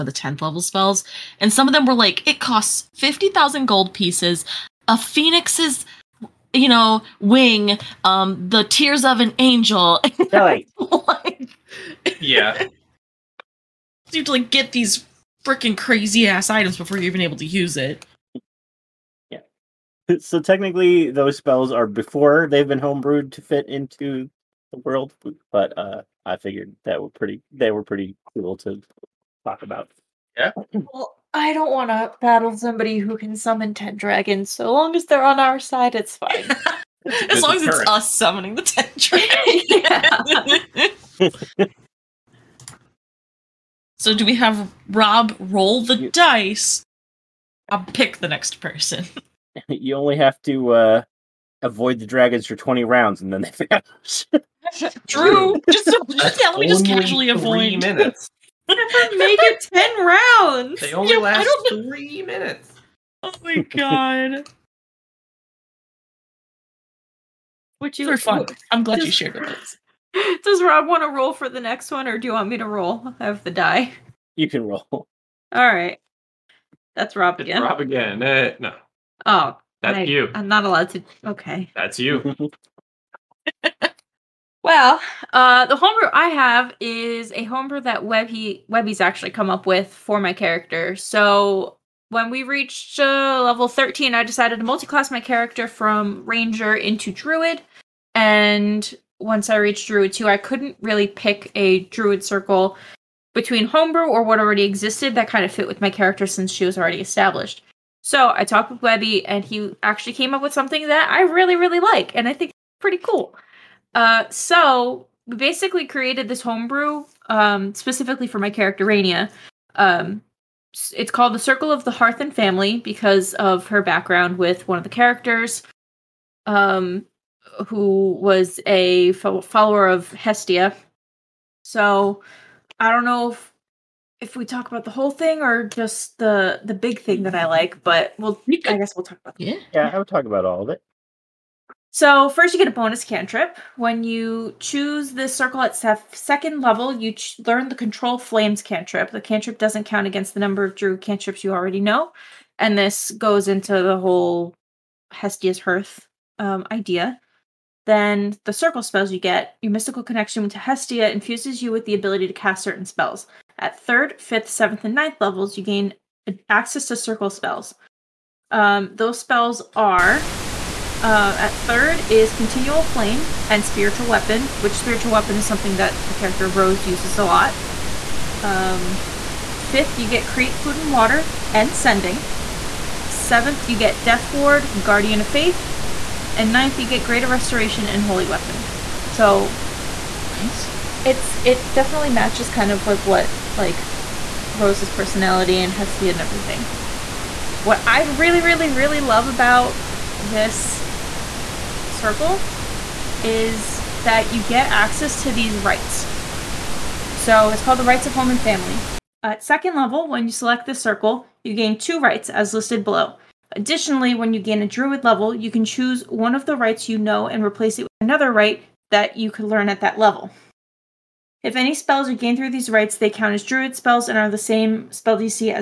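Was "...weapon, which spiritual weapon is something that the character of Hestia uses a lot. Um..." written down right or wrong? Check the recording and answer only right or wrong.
wrong.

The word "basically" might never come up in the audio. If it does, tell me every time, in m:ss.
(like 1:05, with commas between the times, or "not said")
1:55.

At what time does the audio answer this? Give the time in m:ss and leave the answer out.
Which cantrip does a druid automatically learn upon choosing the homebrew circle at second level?
2:27.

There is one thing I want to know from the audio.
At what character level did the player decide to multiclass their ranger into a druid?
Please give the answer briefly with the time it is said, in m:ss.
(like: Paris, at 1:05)
13, at 1:33.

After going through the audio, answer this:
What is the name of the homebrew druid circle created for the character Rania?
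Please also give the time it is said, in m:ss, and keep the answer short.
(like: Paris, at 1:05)
Circle of the Hearth and Family, at 2:01.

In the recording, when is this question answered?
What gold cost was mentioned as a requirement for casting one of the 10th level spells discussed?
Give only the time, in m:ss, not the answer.
0:02.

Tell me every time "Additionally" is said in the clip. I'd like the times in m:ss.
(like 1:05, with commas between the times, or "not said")
3:33.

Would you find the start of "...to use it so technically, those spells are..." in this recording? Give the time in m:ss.
0:17.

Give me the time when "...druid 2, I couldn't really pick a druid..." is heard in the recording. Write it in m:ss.
1:39.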